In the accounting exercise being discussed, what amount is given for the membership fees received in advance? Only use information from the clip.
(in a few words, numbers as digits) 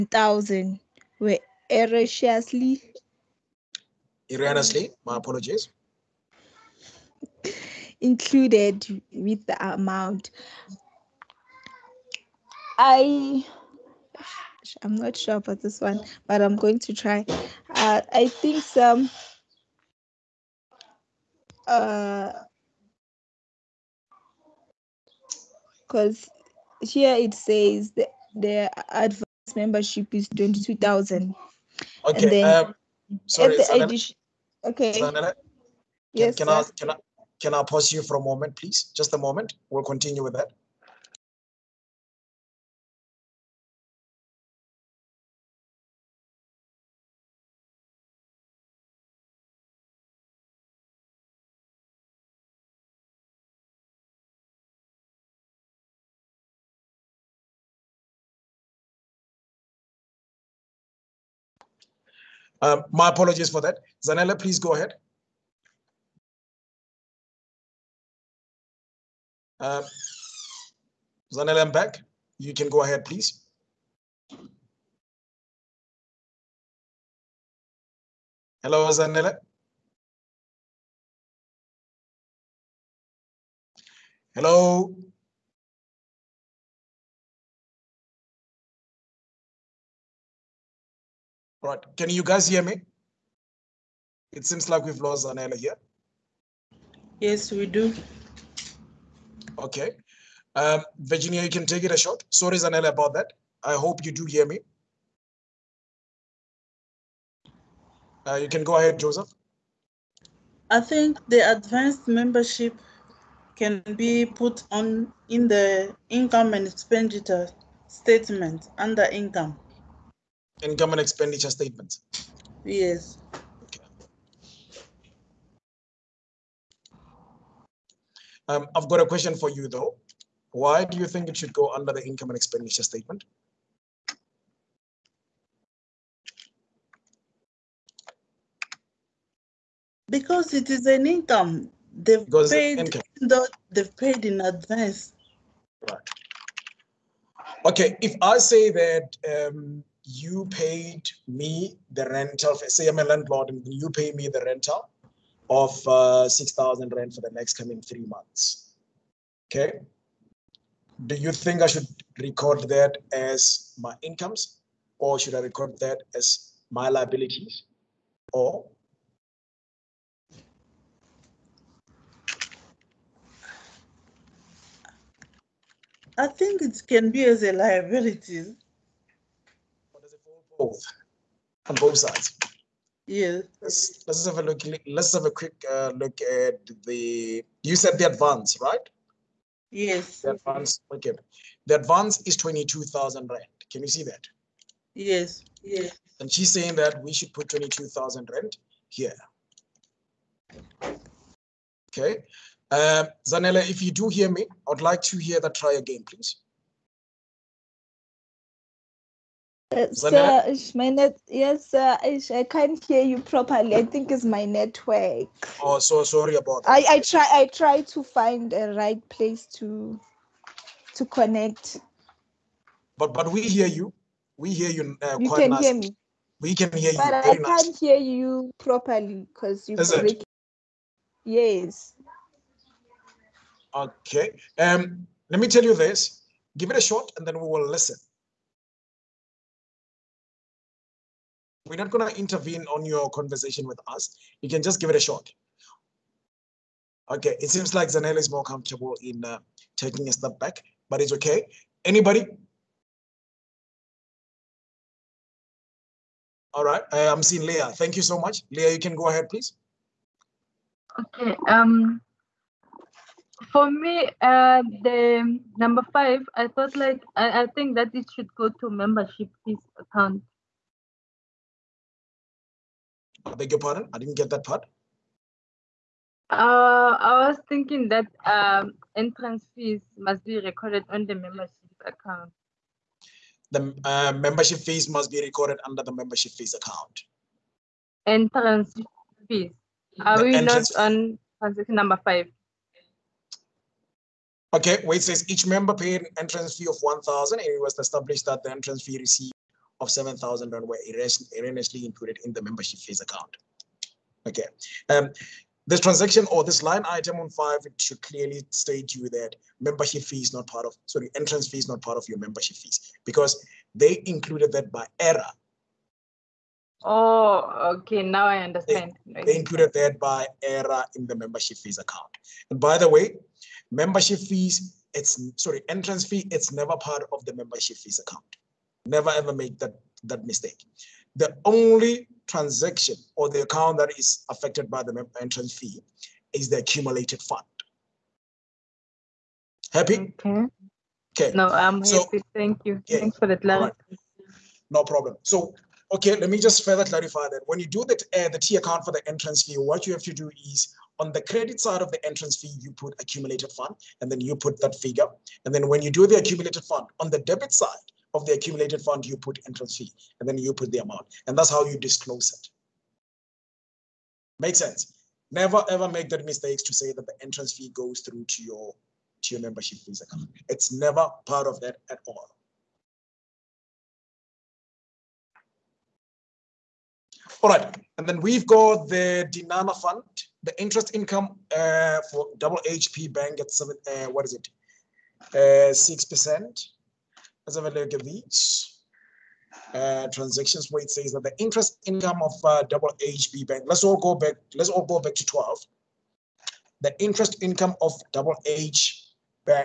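22,000.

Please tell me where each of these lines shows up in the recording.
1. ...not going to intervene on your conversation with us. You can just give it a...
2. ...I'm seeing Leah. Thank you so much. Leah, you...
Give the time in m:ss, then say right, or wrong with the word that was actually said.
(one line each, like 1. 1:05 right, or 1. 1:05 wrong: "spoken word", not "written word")
1. 4:01 right
2. 4:17 right.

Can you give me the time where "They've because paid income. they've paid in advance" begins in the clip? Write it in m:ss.
2:21.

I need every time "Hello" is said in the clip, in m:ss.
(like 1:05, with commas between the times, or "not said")
1:18, 1:24.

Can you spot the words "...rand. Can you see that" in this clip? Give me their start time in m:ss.
3:13.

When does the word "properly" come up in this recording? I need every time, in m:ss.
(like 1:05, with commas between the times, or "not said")
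3:33, 3:48.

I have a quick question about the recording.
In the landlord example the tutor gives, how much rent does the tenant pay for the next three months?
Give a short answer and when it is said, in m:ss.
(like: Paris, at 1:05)
6,000 rand, at 2:36.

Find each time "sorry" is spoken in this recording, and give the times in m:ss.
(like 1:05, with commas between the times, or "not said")
0:33, 1:42, 3:36, 5:10, 5:25.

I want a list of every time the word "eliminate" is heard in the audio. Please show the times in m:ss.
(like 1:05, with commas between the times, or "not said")
not said.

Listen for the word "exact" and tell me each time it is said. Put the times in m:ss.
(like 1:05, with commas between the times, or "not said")
not said.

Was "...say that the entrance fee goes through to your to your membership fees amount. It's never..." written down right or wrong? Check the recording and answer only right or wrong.
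wrong.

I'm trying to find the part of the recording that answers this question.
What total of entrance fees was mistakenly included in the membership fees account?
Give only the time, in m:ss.
4:59.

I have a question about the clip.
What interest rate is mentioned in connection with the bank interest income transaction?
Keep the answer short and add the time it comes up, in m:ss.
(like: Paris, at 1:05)
6%, at 6:25.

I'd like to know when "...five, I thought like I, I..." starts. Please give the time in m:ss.
4:25.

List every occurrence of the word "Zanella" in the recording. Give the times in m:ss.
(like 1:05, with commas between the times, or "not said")
1:04, 1:11, 1:18, 1:42, 3:23, 4:07.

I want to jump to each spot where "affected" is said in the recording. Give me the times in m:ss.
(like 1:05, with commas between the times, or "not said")
5:34.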